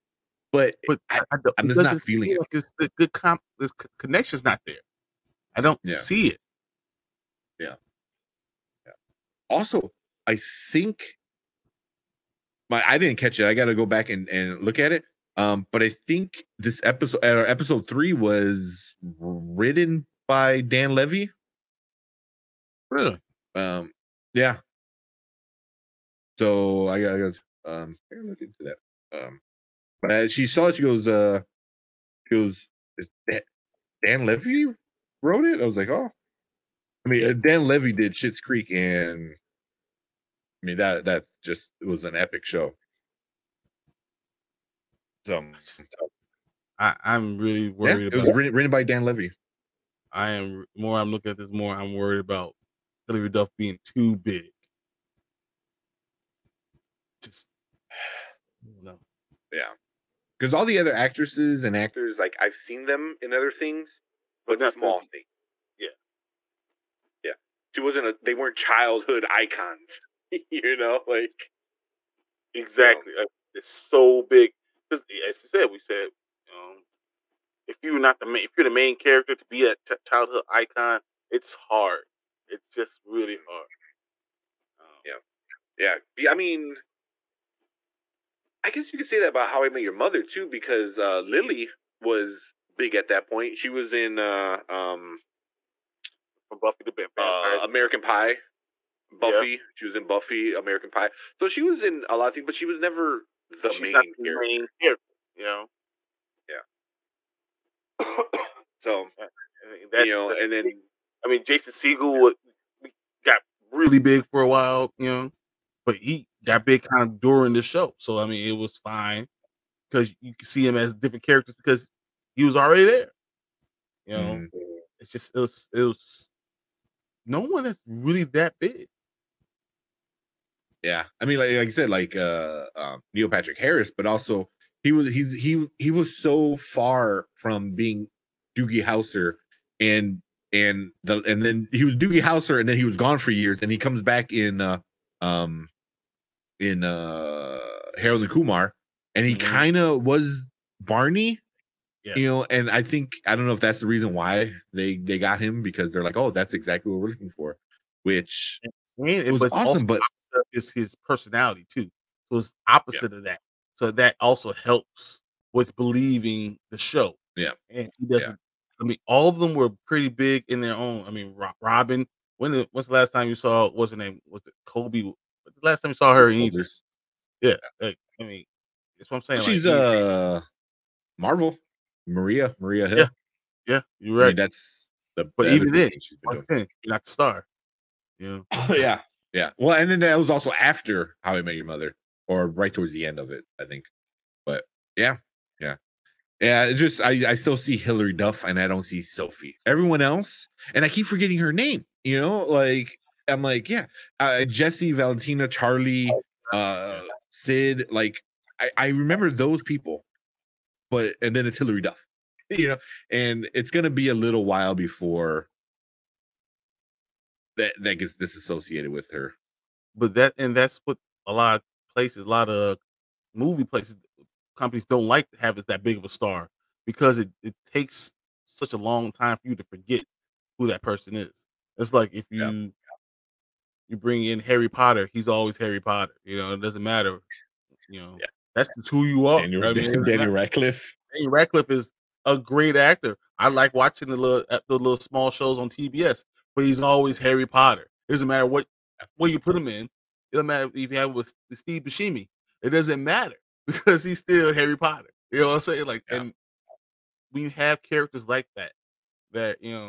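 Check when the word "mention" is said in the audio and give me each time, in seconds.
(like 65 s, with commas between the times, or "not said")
not said.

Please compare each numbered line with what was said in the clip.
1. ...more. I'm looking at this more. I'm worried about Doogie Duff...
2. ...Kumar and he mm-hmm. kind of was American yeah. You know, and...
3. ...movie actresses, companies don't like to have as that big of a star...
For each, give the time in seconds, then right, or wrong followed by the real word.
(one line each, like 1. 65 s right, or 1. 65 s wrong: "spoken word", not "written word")
1. 50 s wrong: "Hilary", not "Doogie"
2. 148 s wrong: "Barney", not "American"
3. 223 s wrong: "places", not "actresses".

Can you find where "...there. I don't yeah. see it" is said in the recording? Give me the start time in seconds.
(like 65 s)
4 s.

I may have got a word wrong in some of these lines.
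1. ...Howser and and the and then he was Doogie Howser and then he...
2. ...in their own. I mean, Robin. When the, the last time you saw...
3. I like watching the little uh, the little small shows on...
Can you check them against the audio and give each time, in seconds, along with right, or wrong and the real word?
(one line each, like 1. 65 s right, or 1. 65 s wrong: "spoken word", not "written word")
1. 138 s right
2. 170 s right
3. 243 s right.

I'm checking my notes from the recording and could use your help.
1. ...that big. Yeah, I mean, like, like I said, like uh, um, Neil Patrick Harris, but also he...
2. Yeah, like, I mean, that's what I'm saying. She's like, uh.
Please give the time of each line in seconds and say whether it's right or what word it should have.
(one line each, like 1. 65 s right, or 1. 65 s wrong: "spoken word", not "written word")
1. 128 s right
2. 177 s right.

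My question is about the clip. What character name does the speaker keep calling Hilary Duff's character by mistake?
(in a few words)
Sophie.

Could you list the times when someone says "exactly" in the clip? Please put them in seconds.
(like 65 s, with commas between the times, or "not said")
72 s, 156 s.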